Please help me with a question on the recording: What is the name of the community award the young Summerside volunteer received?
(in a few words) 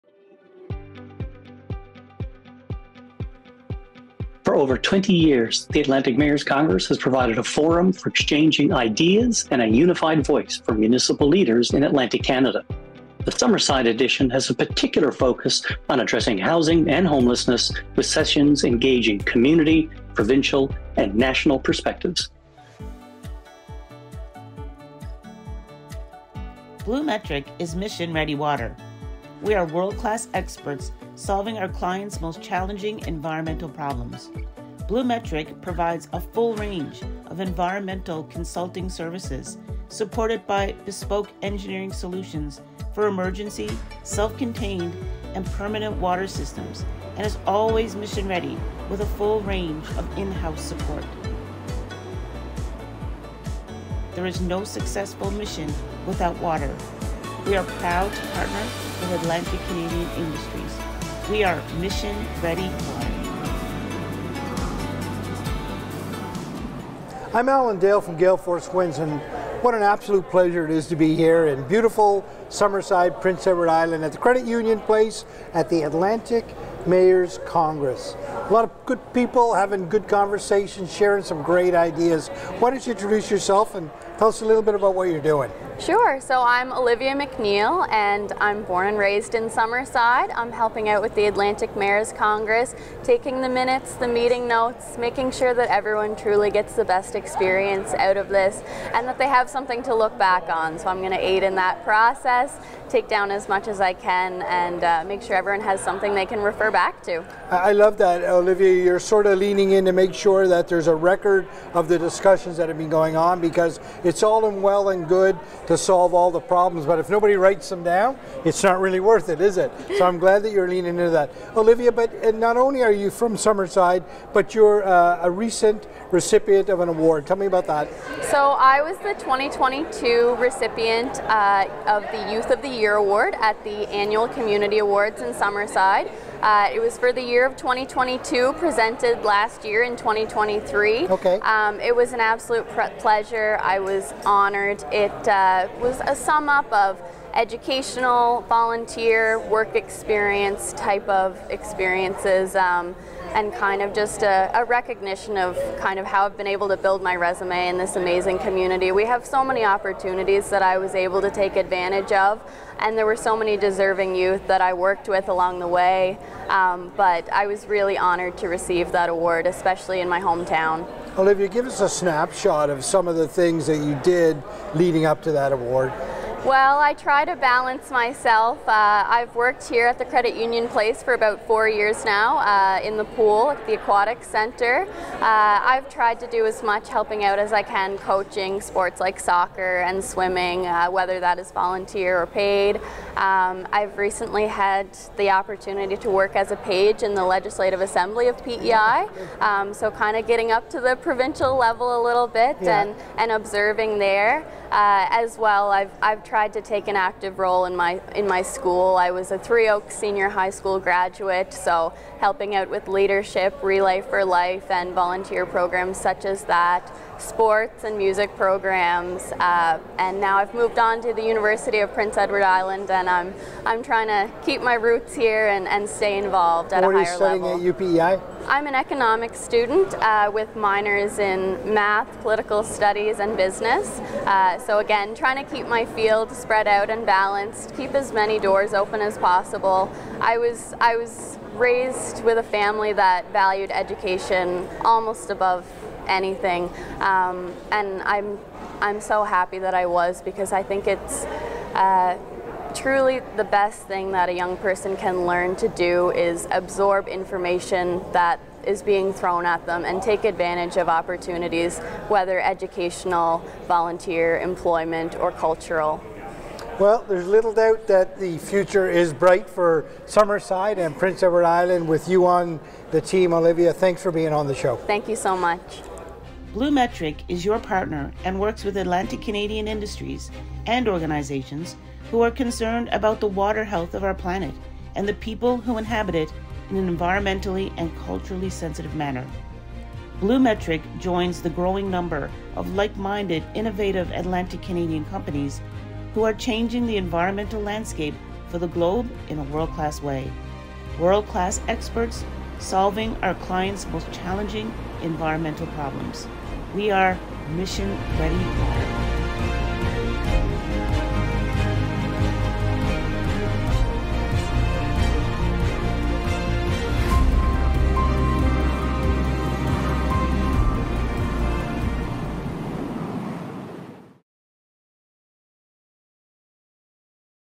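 Youth of the Year Award.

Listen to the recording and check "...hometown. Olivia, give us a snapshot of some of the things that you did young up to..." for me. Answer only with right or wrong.
wrong.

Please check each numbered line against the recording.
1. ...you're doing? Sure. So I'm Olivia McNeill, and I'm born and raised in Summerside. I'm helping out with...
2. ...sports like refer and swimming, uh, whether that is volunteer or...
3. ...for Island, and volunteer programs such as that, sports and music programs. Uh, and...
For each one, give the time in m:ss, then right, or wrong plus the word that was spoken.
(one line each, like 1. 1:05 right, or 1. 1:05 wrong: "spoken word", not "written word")
1. 1:25 right
2. 3:08 wrong: "soccer", not "refer"
3. 3:33 wrong: "Life", not "Island".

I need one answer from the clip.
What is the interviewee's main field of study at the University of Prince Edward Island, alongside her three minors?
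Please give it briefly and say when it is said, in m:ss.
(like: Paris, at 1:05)
Economics, at 3:48.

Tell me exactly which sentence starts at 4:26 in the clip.
Well, there's little doubt that the future is bright for Summerside and Prince Edward Island with you on the team, Olivia.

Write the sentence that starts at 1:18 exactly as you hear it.
A lot of good people having good conversations, sharing some great ideas.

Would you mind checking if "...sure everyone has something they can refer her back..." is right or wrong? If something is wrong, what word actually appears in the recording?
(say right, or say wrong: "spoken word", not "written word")
right.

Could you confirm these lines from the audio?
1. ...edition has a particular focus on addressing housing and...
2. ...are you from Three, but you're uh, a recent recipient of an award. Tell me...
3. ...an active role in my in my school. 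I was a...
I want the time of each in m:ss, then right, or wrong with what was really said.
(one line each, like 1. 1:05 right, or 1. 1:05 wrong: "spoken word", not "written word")
1. 0:13 right
2. 2:02 wrong: "Summerside", not "Three"
3. 3:26 right.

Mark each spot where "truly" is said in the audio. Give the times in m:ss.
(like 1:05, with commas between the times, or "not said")
1:36, 4:12.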